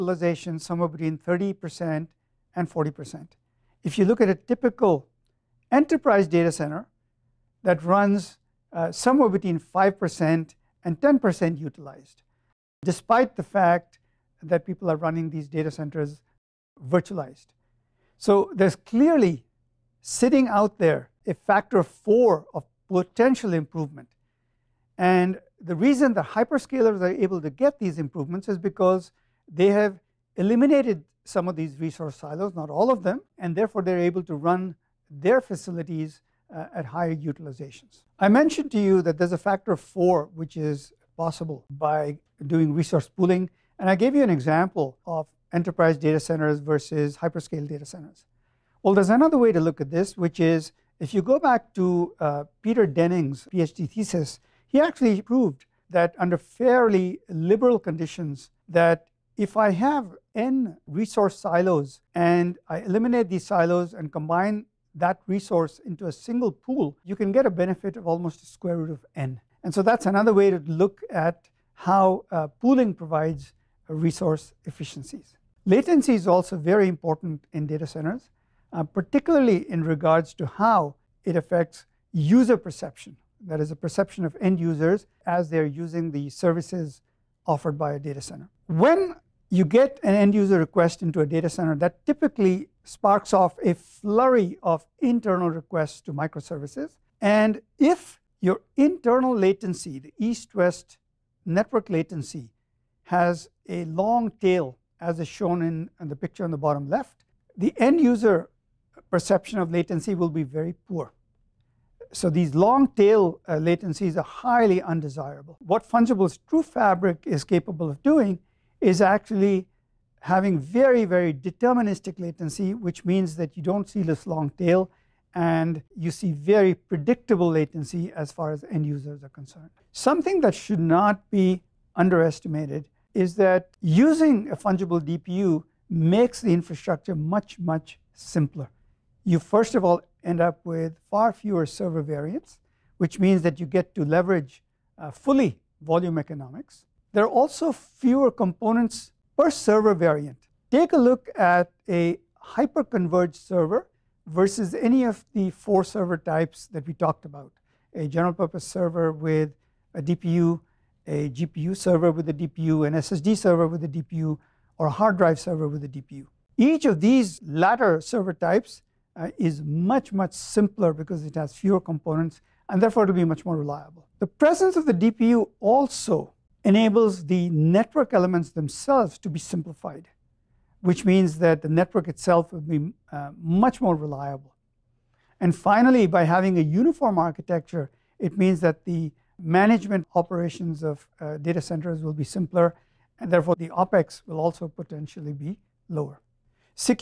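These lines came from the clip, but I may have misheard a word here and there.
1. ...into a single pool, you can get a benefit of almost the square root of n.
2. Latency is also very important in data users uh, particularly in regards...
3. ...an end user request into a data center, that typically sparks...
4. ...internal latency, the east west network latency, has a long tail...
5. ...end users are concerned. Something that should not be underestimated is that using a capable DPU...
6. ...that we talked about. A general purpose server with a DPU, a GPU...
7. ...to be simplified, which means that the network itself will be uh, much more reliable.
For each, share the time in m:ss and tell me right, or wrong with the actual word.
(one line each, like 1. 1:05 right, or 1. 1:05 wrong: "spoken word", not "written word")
1. 1:05 right
2. 1:15 wrong: "centers", not "users"
3. 1:30 right
4. 1:38 right
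5. 2:08 wrong: "fungible", not "capable"
6. 2:36 right
7. 2:59 right.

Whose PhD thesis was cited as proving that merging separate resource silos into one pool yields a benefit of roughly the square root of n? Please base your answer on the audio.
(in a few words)
Peter Denning.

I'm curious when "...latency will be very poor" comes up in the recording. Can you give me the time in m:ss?
1:49.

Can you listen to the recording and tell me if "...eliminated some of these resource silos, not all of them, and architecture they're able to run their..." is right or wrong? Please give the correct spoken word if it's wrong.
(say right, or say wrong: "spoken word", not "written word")
wrong: "therefore", not "architecture".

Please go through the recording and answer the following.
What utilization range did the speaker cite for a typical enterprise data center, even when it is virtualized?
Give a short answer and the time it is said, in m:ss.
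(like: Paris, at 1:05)
5% to 10%, at 0:09.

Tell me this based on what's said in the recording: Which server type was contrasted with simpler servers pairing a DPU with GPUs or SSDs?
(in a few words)
hyperconverged server.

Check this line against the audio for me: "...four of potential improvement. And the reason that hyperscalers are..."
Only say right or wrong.
right.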